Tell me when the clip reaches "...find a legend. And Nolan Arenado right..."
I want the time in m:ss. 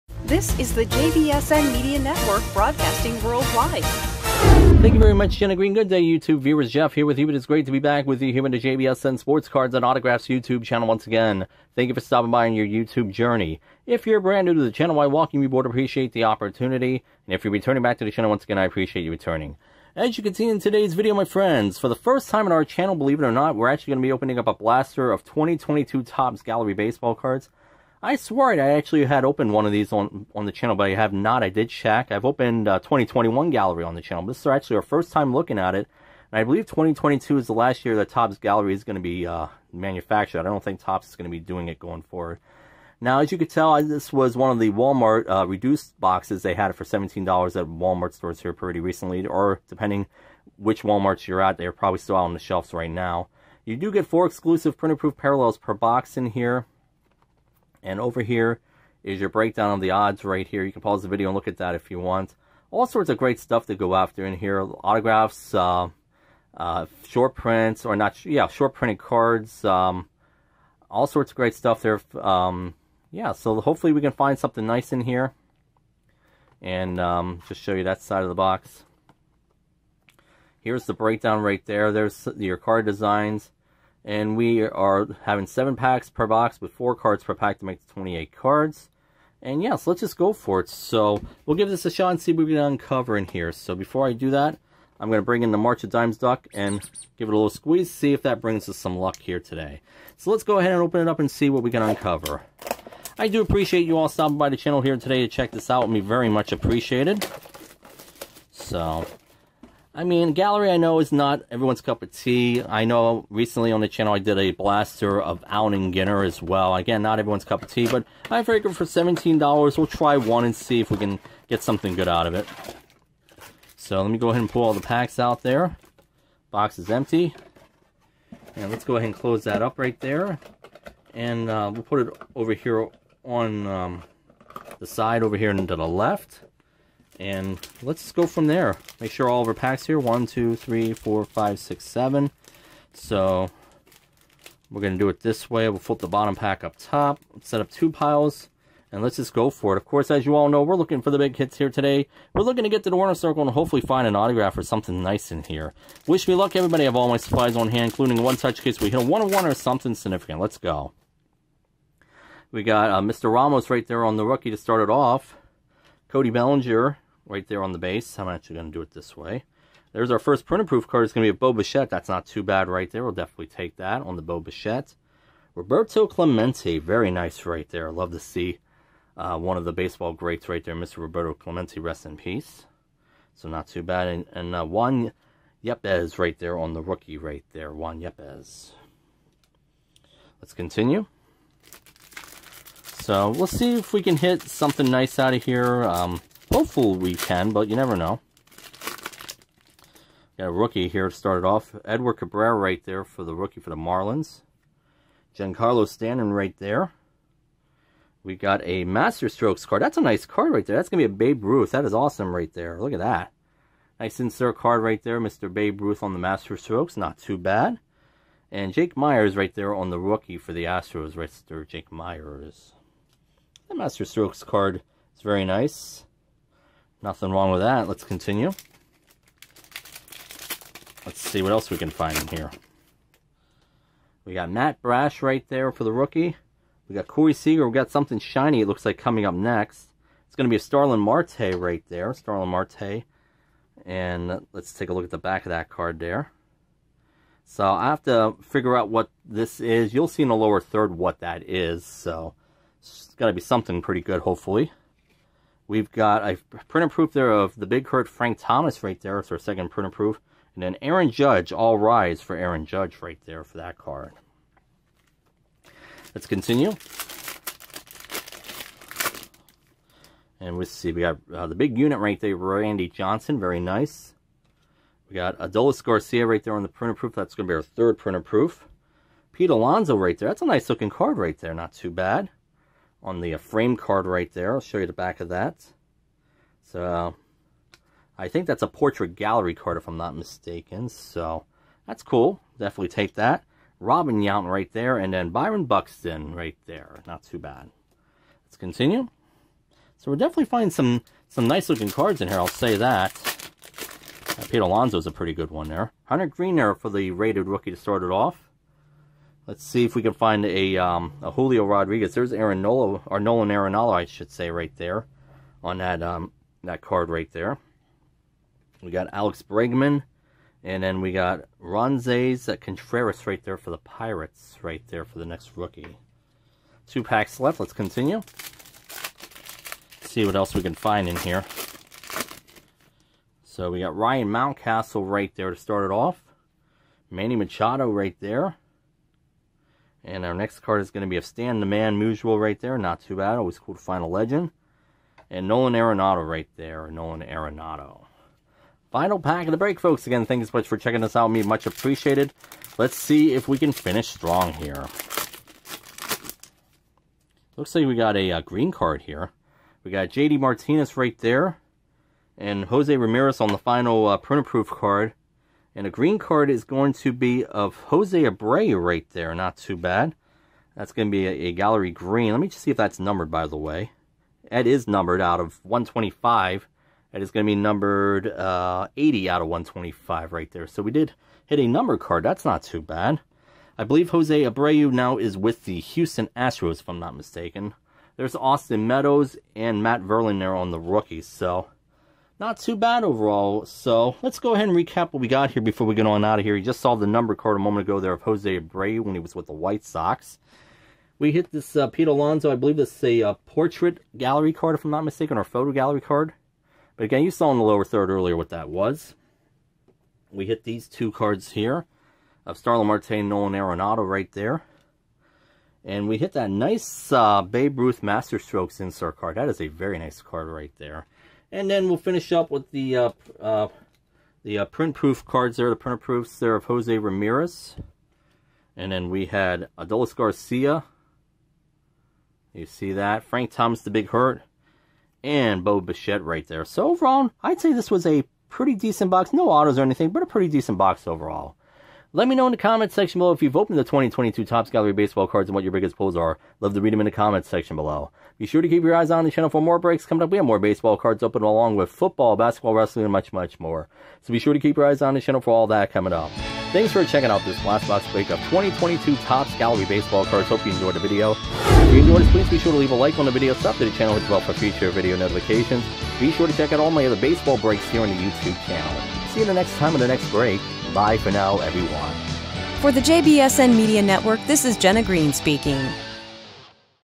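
5:43.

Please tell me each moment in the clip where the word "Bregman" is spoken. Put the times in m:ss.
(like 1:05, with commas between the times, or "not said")
5:19.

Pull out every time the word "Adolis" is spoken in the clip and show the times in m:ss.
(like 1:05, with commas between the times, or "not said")
4:35, 7:09.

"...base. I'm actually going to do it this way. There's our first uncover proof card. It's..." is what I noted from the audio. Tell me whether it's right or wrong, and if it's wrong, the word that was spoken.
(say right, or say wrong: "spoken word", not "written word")
wrong: "printer", not "uncover".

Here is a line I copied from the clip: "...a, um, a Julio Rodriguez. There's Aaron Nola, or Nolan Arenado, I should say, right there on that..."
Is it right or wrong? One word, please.
right.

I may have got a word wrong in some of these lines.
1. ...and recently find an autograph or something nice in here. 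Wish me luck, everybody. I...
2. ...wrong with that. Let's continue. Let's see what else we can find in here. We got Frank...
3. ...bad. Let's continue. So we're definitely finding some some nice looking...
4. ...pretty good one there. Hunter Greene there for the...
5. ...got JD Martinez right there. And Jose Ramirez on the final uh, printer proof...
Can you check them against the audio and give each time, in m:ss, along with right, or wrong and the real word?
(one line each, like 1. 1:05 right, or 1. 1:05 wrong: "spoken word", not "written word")
1. 2:33 wrong: "hopefully", not "recently"
2. 3:47 wrong: "Matt", not "Frank"
3. 4:57 right
4. 5:05 right
5. 5:59 right.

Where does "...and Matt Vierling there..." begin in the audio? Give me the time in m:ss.
6:29.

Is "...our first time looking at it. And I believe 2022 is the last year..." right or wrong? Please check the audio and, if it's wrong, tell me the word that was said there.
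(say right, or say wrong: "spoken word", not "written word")
right.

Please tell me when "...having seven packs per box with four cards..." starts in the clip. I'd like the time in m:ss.
1:25.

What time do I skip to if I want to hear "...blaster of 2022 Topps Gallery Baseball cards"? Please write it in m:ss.
0:24.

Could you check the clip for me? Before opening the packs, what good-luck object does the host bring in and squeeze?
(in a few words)
March of Dimes Duck.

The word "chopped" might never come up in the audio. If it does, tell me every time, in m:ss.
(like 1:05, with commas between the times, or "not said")
not said.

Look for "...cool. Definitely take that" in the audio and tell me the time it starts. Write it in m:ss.
4:52.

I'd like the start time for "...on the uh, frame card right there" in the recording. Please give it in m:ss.
4:43.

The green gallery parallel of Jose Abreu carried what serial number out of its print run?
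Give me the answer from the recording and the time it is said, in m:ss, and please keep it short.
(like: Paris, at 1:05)
80, at 6:18.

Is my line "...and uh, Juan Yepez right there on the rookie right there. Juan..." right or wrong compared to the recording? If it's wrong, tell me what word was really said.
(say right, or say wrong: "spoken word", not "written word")
right.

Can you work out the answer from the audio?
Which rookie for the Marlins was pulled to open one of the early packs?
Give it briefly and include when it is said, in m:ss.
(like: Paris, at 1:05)
Edward Cabrera, at 3:21.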